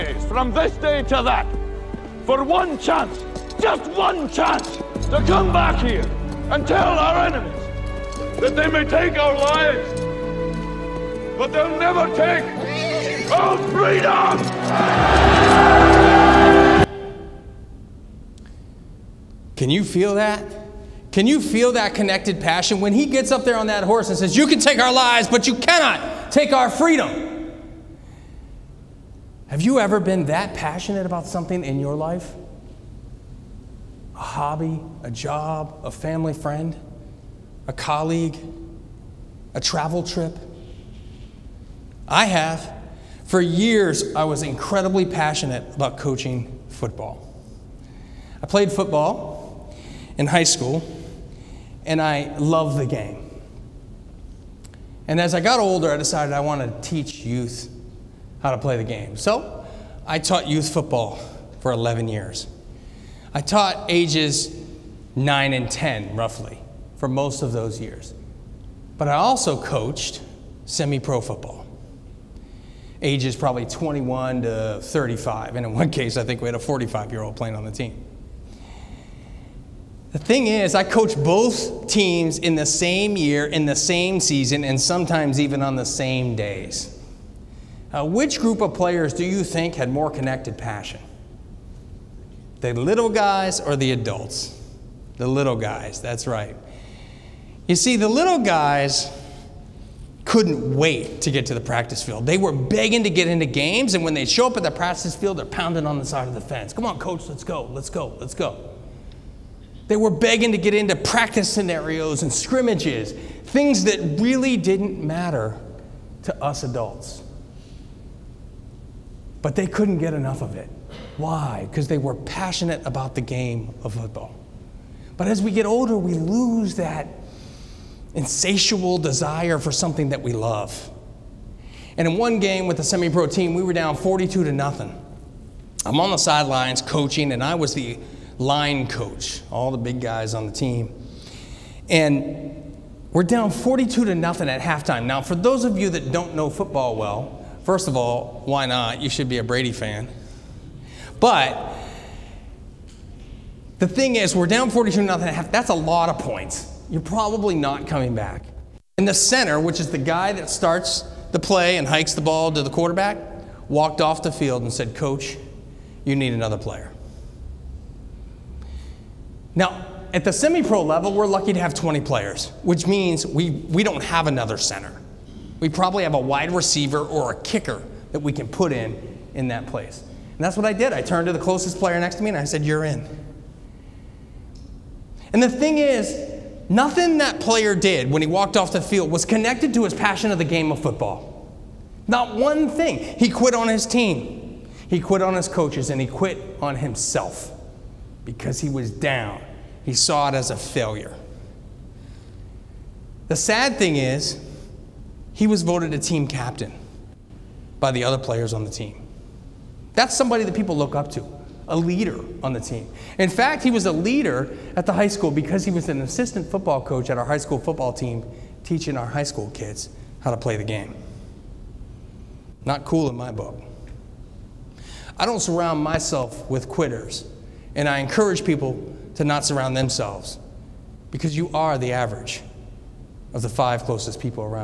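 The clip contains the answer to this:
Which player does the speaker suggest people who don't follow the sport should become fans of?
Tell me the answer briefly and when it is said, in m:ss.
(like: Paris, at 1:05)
Brady, at 2:29.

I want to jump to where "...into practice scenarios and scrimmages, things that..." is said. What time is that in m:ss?
1:50.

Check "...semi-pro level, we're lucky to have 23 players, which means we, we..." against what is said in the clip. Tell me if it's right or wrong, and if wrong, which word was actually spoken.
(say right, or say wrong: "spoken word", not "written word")
wrong: "20", not "23".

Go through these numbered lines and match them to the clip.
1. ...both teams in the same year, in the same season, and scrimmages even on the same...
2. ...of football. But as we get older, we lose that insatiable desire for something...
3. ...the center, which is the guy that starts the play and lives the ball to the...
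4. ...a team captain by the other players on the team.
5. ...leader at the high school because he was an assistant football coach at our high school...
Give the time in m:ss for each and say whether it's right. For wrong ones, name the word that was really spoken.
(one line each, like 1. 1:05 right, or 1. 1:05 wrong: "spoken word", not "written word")
1. 1:21 wrong: "sometimes", not "scrimmages"
2. 2:03 right
3. 2:39 wrong: "hikes", not "lives"
4. 3:25 right
5. 3:33 right.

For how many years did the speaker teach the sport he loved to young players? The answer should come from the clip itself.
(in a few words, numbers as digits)
11.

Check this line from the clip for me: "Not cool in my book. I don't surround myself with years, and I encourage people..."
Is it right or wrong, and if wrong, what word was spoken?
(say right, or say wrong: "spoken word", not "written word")
wrong: "quitters", not "years".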